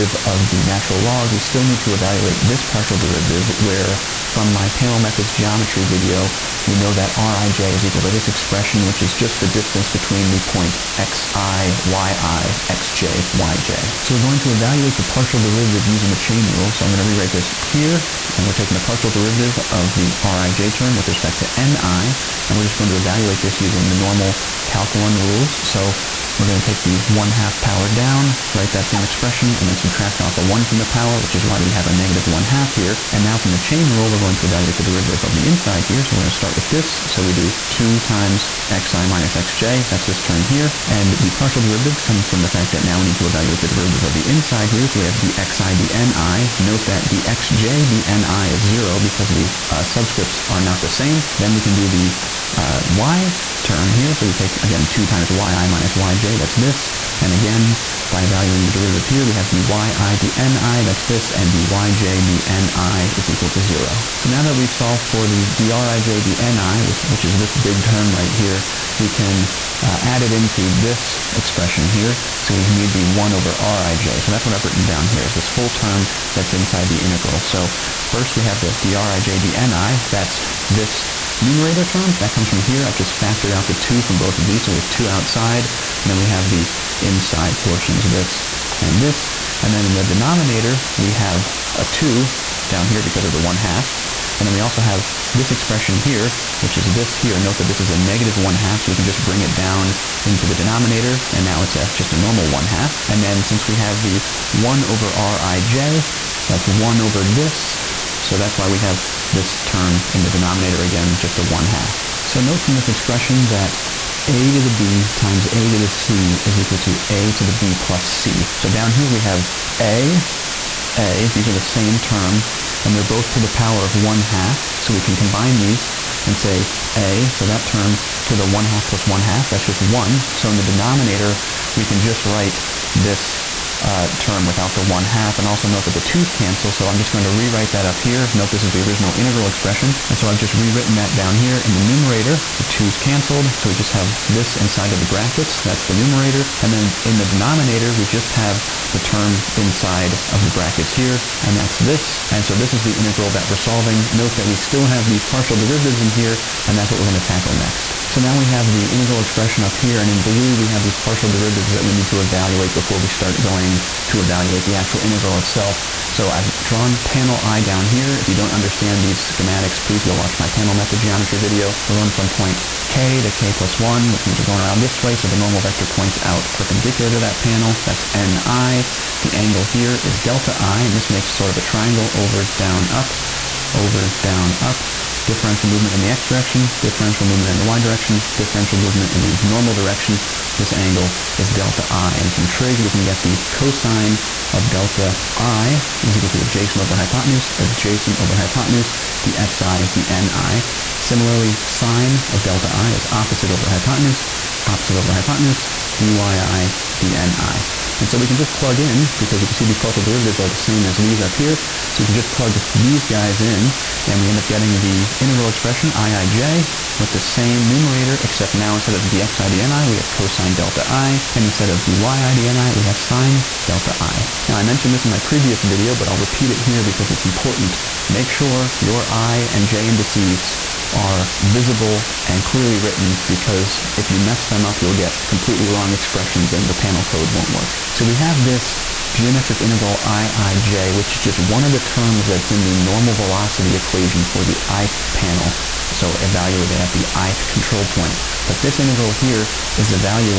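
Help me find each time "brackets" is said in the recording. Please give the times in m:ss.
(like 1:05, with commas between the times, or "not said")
2:25, 2:30.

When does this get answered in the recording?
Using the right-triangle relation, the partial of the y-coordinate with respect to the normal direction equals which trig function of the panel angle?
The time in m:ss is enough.
3:21.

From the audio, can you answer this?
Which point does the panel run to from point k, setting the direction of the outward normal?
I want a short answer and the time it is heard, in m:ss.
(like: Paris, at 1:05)
k plus 1, at 2:53.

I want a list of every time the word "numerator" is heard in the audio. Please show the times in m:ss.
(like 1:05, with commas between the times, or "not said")
1:21, 2:21, 2:25, 3:37.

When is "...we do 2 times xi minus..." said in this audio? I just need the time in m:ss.
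0:37.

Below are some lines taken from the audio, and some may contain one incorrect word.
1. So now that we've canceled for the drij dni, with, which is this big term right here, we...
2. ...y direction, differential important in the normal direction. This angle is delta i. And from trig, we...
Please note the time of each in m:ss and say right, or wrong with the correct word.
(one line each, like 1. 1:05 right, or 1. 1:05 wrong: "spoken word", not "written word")
1. 1:04 wrong: "solved", not "canceled"
2. 3:07 wrong: "movement", not "important".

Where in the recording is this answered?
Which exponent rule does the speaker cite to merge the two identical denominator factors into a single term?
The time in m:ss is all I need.
1:57.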